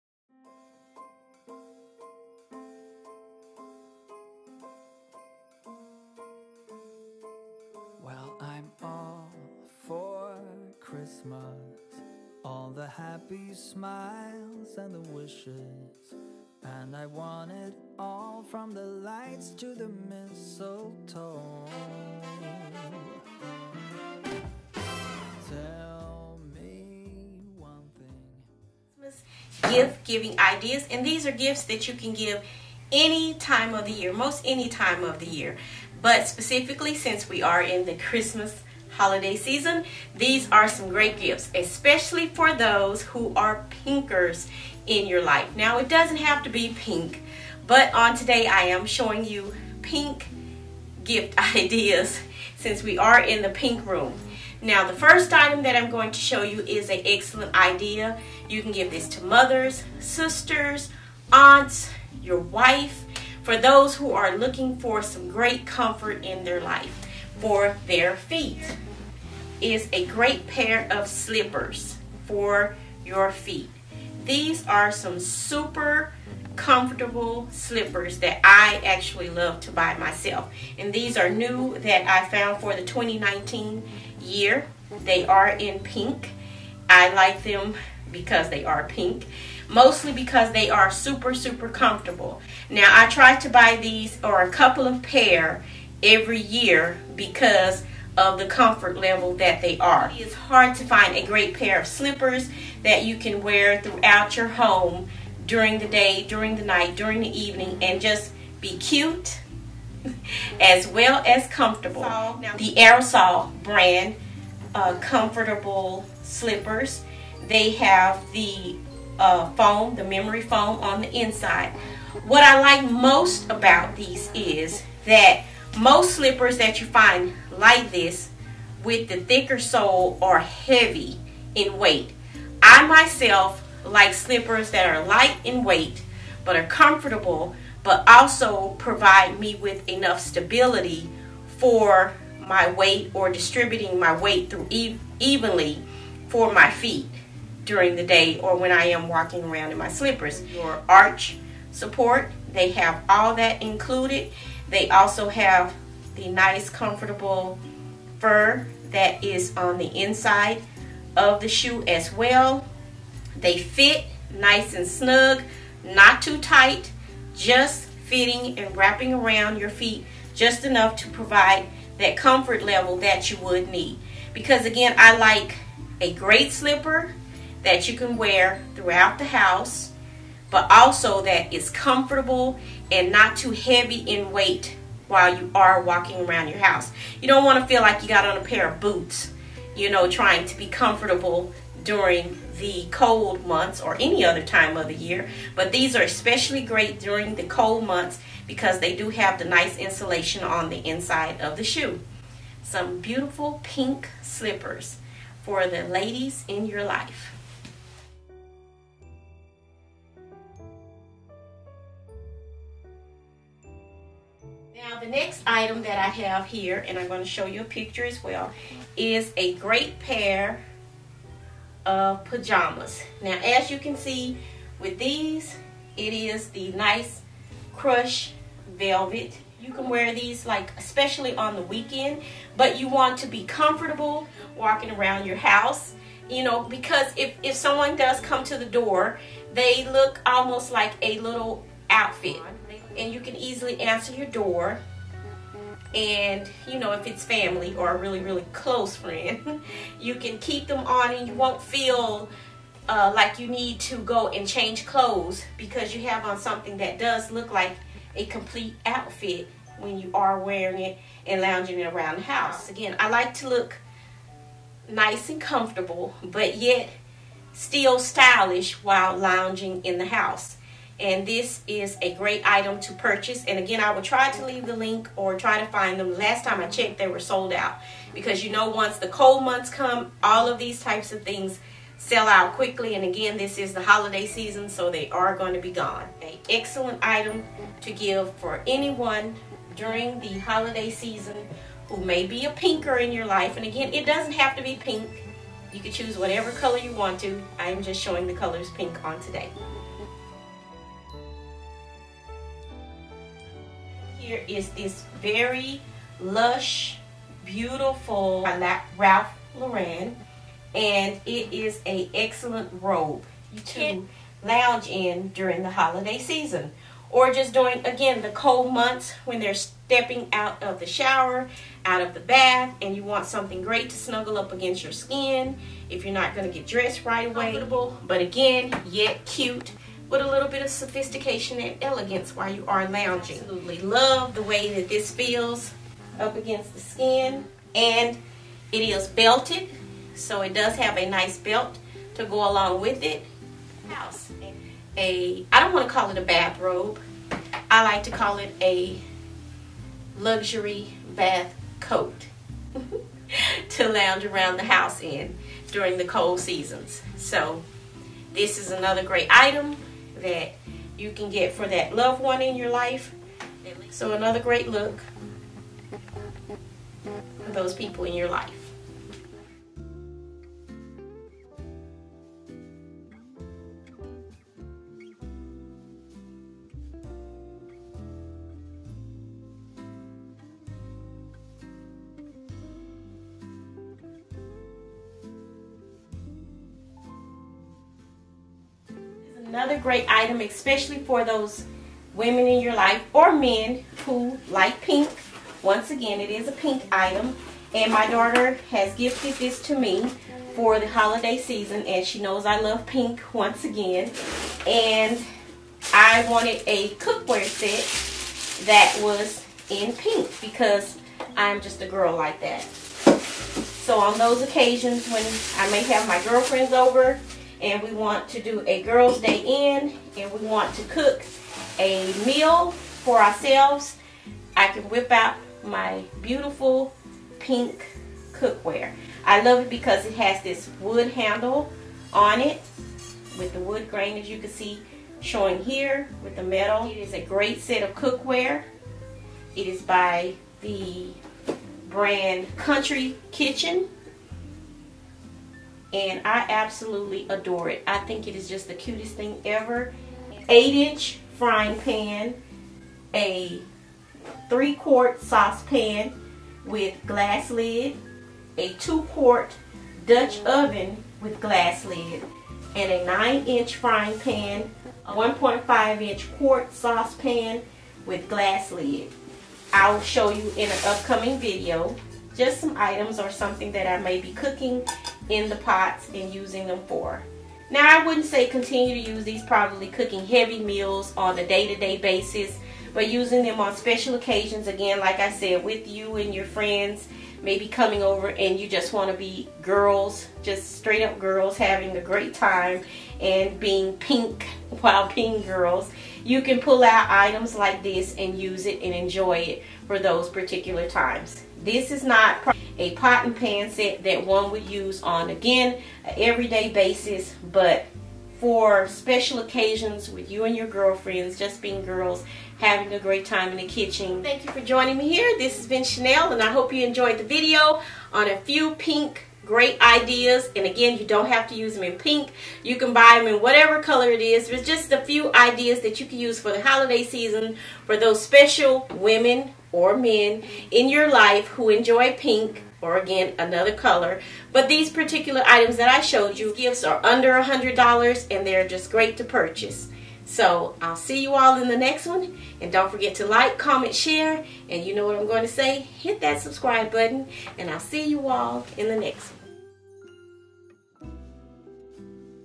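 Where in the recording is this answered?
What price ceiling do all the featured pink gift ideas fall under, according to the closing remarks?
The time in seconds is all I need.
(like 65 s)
537 s.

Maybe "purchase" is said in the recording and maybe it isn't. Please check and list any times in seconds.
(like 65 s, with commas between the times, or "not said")
272 s, 539 s.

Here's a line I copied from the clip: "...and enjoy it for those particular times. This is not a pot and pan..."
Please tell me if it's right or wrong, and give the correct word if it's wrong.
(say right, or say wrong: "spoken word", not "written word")
right.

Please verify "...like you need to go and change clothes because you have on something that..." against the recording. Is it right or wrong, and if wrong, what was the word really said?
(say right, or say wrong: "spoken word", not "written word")
right.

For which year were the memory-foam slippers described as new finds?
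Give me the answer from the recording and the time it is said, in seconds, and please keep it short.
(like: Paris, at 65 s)
2019, at 82 s.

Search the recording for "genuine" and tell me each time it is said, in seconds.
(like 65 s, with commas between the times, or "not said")
not said.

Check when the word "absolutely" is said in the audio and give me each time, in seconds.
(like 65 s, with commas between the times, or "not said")
333 s, 446 s.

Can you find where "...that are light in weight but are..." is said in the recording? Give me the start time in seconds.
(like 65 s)
134 s.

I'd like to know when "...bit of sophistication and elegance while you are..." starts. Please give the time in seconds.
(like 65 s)
330 s.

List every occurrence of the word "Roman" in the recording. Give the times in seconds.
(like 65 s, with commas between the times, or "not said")
not said.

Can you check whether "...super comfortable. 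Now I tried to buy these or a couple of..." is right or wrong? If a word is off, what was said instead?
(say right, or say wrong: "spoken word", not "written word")
right.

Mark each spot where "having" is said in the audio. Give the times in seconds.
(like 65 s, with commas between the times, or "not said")
491 s, 512 s.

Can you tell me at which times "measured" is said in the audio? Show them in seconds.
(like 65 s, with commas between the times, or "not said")
not said.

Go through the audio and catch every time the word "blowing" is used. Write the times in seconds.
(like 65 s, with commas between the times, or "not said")
not said.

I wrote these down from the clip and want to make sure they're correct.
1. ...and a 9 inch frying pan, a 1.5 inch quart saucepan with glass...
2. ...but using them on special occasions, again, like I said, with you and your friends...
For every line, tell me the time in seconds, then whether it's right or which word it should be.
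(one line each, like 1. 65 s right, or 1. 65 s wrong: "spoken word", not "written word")
1. 462 s right
2. 482 s right.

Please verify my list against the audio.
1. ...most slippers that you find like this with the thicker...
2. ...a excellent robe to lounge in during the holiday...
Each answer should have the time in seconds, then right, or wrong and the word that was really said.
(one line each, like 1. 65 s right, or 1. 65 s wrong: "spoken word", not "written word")
1. 125 s right
2. 311 s right.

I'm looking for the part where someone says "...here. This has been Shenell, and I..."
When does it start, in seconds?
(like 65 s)
515 s.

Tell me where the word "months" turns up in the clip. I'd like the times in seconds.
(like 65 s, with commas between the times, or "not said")
193 s, 197 s, 279 s, 318 s.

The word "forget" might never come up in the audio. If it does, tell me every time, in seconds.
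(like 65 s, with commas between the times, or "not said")
542 s.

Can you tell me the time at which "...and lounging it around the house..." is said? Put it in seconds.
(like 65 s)
261 s.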